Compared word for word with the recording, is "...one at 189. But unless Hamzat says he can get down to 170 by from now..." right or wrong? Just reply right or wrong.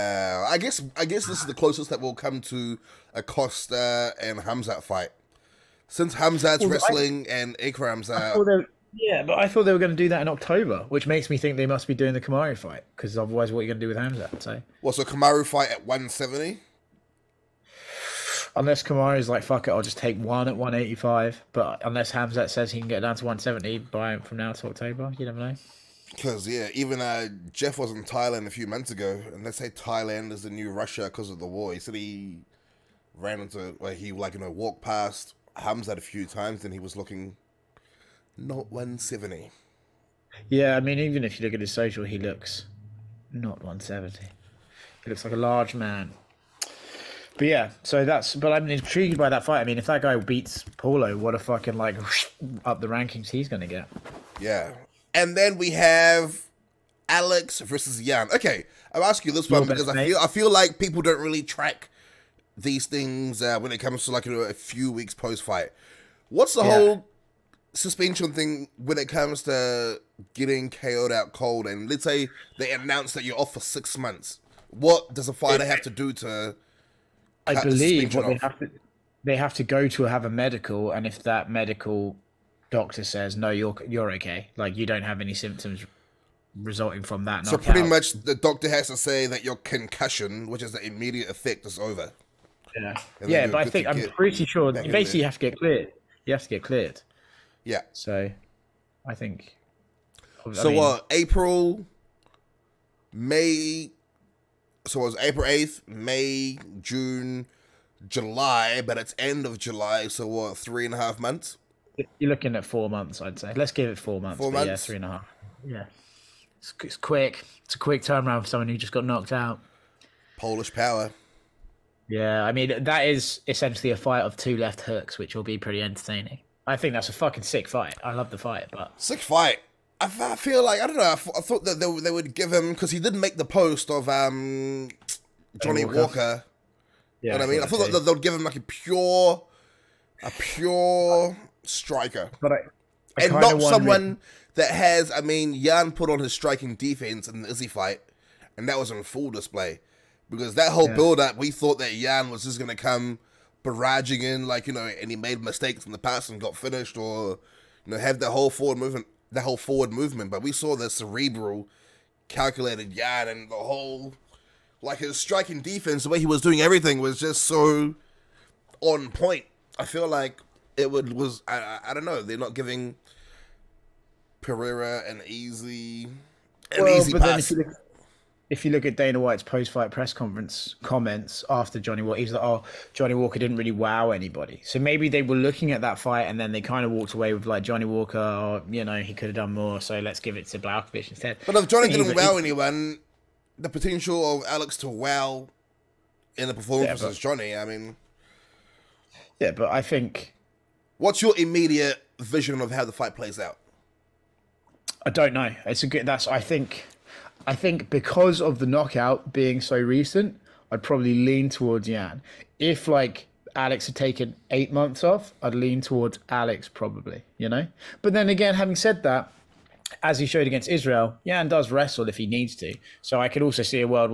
wrong.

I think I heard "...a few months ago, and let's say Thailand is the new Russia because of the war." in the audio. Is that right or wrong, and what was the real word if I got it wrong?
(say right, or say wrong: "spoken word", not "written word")
right.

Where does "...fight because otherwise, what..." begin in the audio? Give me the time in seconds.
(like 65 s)
12 s.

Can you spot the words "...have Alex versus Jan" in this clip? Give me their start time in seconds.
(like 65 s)
55 s.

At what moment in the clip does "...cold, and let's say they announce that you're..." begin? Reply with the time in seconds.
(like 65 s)
71 s.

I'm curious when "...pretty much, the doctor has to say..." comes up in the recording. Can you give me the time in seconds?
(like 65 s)
87 s.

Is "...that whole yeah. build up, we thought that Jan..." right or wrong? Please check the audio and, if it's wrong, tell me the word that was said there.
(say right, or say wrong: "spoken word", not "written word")
right.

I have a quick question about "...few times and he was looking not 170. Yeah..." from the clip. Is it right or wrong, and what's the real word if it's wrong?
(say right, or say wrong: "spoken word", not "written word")
right.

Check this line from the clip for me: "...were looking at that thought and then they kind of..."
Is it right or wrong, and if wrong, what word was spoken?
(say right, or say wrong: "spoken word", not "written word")
wrong: "fight", not "thought".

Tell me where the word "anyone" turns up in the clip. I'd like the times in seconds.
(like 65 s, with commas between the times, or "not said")
192 s.